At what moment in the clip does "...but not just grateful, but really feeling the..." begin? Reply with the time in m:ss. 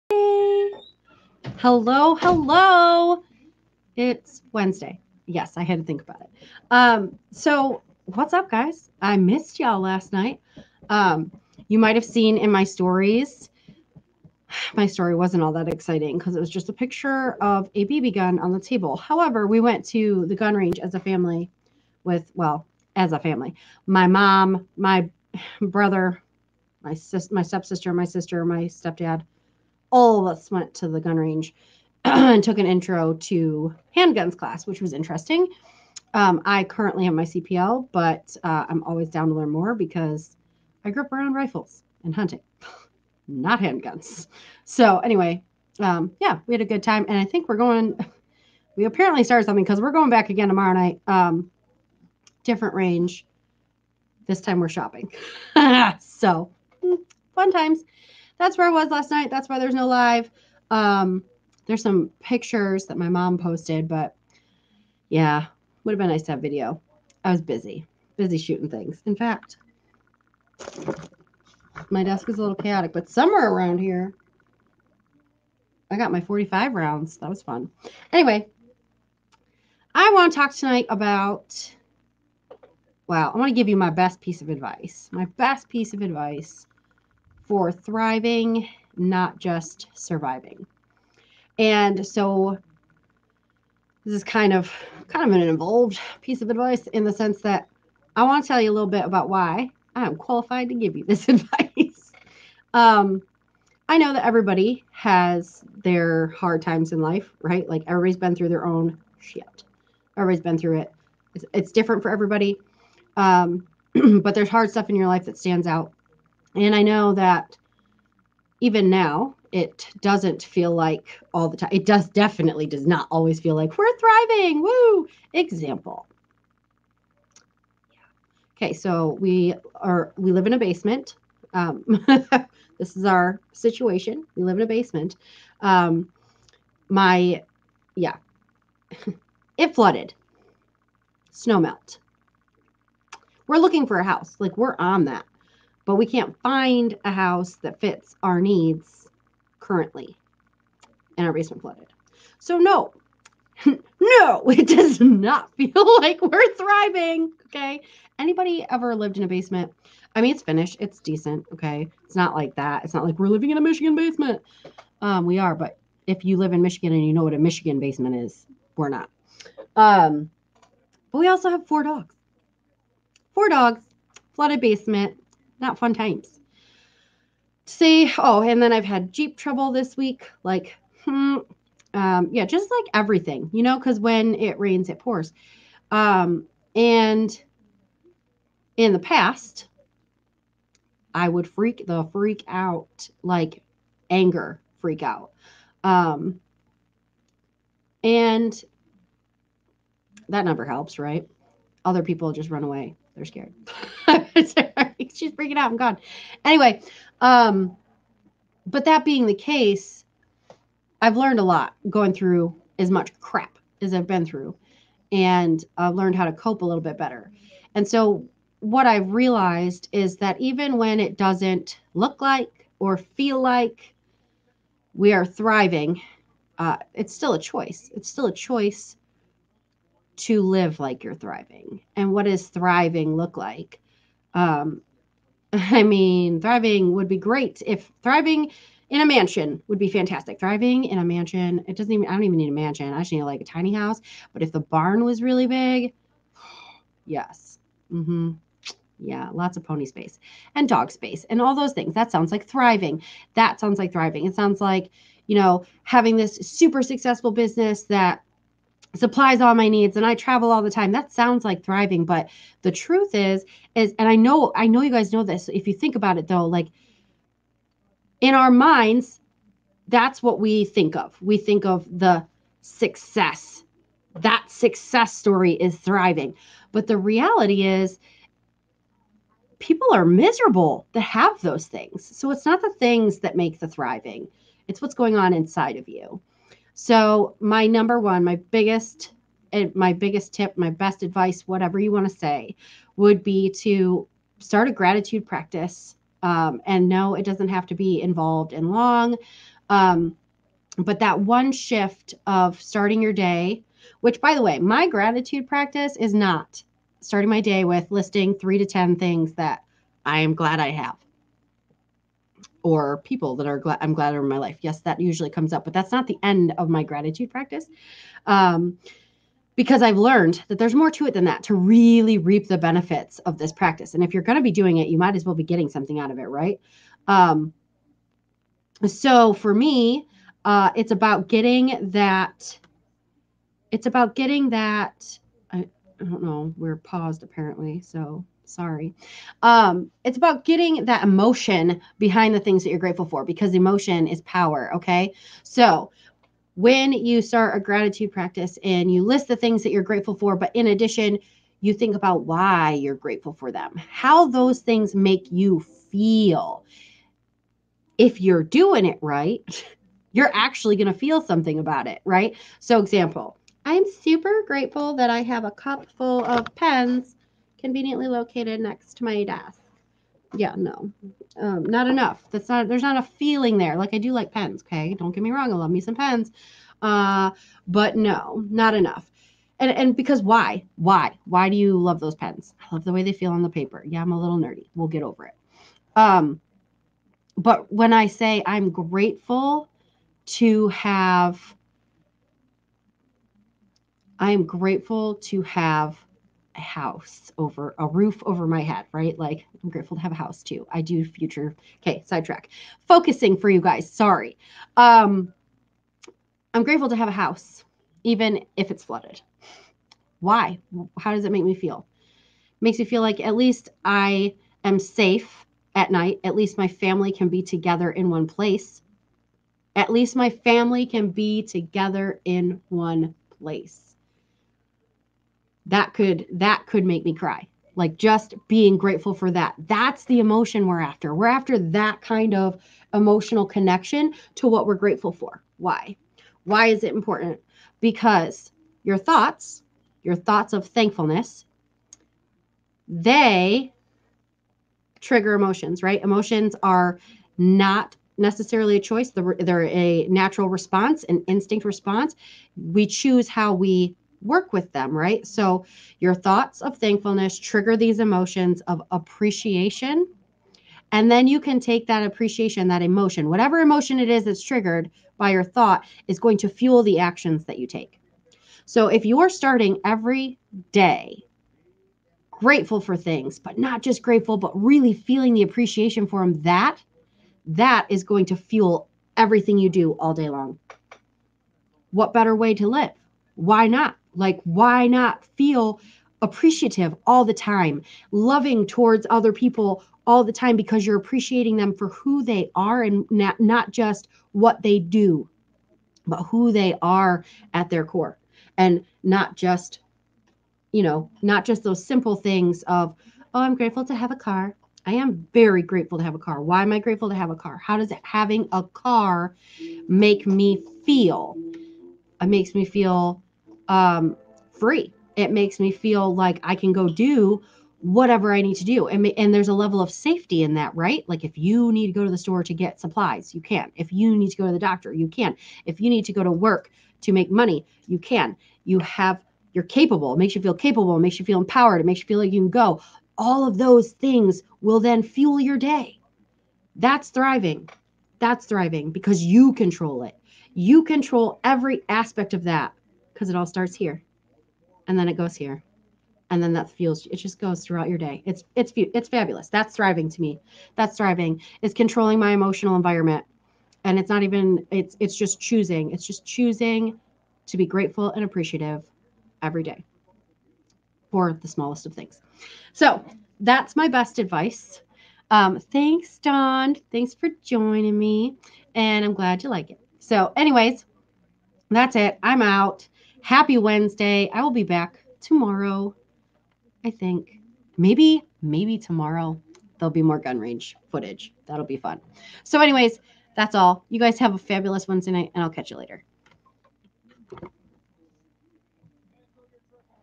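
7:53.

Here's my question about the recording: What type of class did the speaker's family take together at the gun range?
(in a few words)
Intro to handguns.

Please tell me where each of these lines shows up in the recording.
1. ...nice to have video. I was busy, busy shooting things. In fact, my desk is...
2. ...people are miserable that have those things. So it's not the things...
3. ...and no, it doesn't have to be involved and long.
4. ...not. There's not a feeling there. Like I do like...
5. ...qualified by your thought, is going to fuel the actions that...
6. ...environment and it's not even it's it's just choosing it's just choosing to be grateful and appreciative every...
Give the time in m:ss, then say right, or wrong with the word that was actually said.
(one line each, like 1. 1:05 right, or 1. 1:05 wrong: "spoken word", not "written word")
1. 1:06 right
2. 4:39 right
3. 4:56 right
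4. 6:12 right
5. 7:44 wrong: "triggered", not "qualified"
6. 9:12 right.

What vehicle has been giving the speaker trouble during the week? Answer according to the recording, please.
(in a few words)
Jeep.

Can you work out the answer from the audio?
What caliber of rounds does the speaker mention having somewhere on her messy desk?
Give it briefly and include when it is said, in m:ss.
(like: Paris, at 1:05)
45, at 1:16.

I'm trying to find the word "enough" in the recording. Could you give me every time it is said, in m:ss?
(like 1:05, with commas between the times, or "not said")
6:11, 6:18.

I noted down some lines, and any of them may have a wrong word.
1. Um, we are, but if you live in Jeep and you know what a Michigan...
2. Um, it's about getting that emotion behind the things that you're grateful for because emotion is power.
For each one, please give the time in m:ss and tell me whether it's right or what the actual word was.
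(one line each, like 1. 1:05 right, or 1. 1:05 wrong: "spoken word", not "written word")
1. 2:45 wrong: "Michigan", not "Jeep"
2. 5:39 right.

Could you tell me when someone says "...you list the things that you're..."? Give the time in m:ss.
5:48.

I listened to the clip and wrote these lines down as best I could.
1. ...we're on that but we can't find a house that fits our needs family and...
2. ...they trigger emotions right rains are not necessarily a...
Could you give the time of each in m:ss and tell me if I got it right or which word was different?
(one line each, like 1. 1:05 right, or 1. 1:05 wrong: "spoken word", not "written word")
1. 2:24 wrong: "currently", not "family"
2. 7:22 wrong: "emotions", not "rains".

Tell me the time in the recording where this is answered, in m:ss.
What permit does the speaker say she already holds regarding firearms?
0:37.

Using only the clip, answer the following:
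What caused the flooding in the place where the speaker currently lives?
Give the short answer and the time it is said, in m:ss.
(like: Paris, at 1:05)
Snow melt, at 2:21.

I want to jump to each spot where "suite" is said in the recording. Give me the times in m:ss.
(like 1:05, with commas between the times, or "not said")
not said.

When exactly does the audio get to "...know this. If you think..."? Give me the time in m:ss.
4:25.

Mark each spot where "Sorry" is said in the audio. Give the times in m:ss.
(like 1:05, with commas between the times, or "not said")
5:38, 6:43.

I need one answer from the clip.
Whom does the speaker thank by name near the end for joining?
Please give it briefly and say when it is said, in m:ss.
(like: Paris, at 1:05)
Don, at 9:26.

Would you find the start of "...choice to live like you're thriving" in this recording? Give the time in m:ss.
3:48.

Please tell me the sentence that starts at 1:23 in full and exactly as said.
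Well, I want to give you my best piece of advice.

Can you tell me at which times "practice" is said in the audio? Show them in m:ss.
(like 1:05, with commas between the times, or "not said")
4:55, 5:05, 5:17, 5:23, 5:48.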